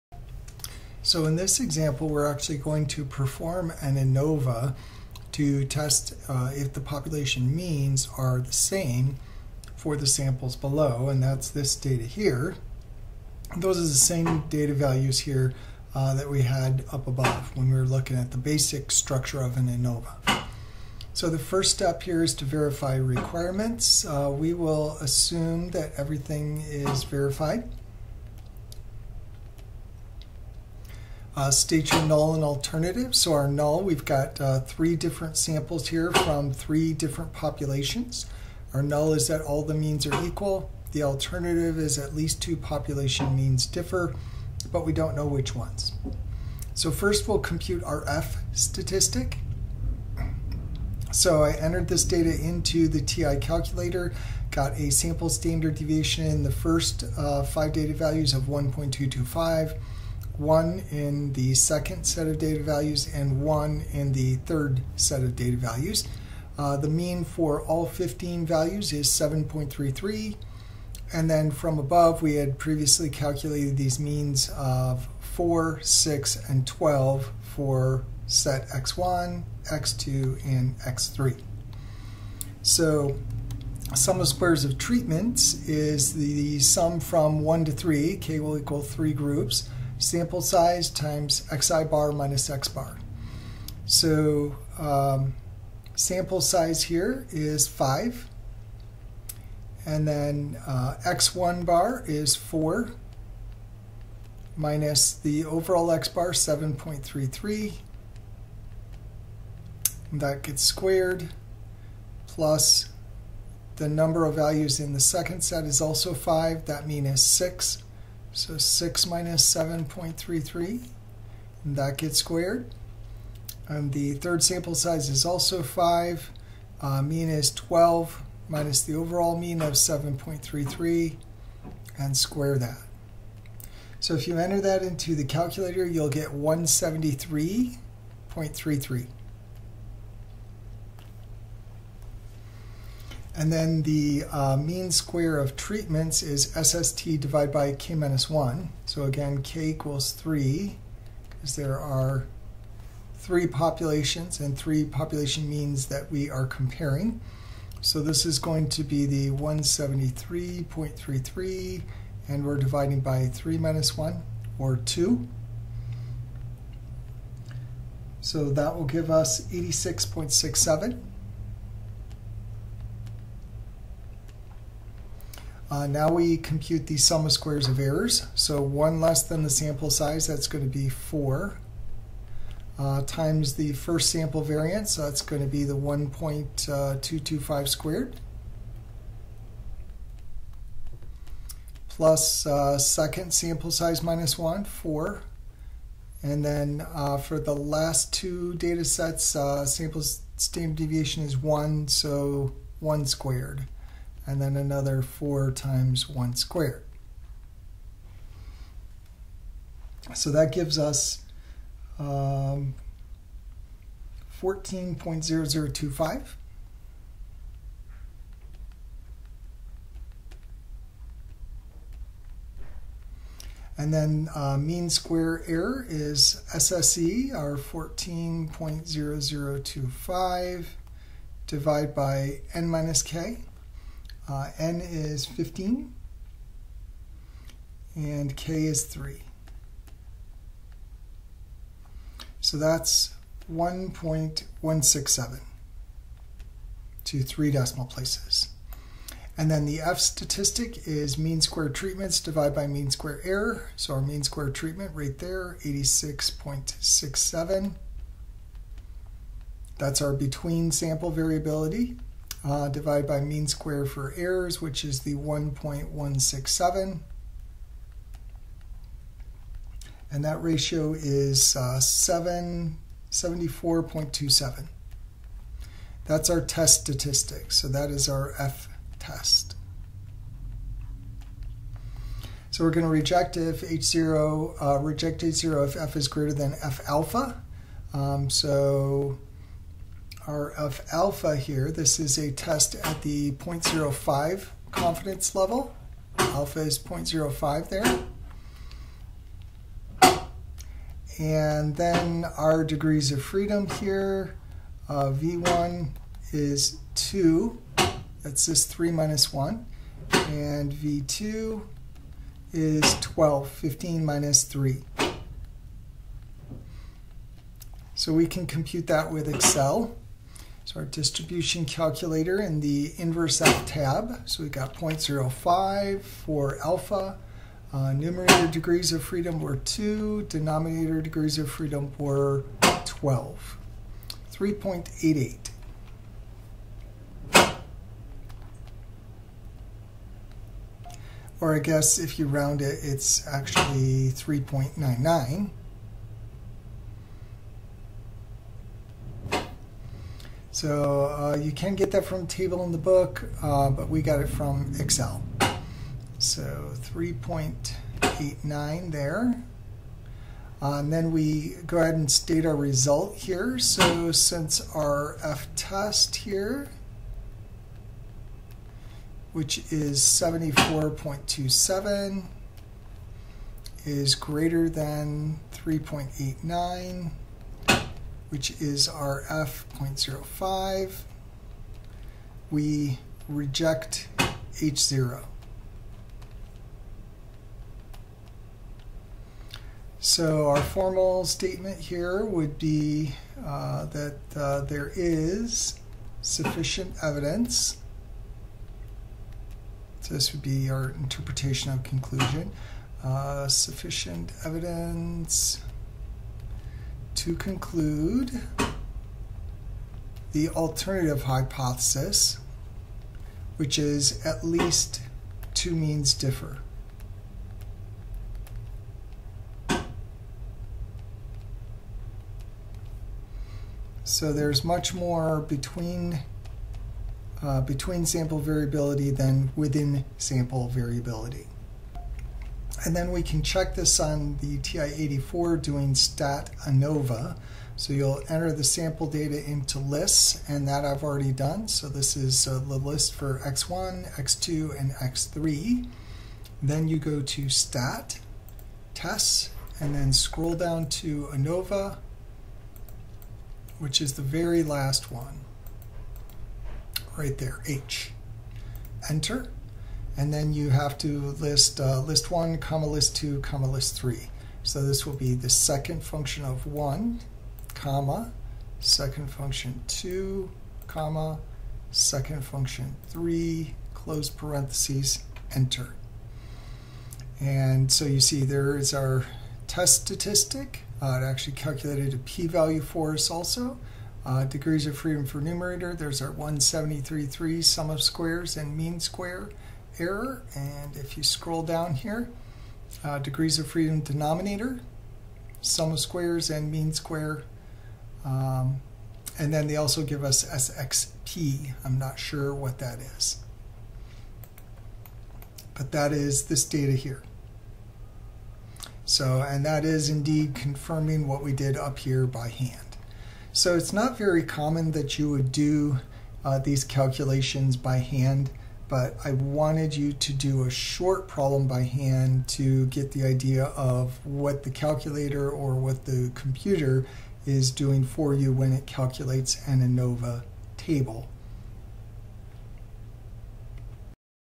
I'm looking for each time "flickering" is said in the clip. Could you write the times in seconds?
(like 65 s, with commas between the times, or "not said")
not said.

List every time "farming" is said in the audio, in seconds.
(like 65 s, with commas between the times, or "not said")
not said.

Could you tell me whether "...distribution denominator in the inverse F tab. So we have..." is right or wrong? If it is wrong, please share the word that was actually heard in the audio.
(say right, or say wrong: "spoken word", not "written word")
wrong: "calculator", not "denominator".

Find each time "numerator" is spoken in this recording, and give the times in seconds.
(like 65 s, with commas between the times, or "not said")
327 s, 485 s.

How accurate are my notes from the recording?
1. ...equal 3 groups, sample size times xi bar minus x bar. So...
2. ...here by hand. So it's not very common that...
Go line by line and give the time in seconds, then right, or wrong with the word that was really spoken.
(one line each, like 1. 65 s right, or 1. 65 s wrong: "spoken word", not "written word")
1. 88 s right
2. 511 s right.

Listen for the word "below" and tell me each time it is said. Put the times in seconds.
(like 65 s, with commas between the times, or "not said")
10 s.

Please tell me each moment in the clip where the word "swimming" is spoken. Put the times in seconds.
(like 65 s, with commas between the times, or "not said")
not said.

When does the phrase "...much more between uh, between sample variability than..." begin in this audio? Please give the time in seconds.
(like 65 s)
424 s.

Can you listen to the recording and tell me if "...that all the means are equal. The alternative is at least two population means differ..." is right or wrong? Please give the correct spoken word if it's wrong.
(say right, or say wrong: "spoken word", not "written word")
right.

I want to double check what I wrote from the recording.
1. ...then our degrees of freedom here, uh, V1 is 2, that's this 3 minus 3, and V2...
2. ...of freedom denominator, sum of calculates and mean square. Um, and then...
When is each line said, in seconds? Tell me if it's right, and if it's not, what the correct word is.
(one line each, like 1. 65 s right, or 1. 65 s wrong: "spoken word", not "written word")
1. 301 s wrong: "1", not "3"
2. 493 s wrong: "squares", not "calculates".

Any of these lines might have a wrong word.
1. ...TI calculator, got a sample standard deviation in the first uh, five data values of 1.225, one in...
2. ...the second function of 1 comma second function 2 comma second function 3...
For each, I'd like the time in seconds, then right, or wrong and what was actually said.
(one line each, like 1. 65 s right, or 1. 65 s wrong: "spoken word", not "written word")
1. 53 s right
2. 465 s right.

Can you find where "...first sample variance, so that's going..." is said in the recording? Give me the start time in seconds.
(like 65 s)
183 s.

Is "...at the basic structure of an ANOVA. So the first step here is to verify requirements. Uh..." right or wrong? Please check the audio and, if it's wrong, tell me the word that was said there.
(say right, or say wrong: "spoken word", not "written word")
right.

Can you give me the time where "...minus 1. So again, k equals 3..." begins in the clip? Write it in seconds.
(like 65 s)
147 s.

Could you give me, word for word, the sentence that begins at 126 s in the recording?
Uh, mean is 12 minus the overall mean of 7.33 and square that.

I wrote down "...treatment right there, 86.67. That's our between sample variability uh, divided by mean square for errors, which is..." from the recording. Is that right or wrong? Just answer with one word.
right.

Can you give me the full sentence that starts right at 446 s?
Then you go to stat, tests, and then scroll down to ANOVA, which is the very last one, right there, H.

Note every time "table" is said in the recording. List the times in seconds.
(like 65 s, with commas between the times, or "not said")
352 s, 530 s.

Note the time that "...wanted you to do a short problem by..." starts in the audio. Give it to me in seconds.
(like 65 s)
519 s.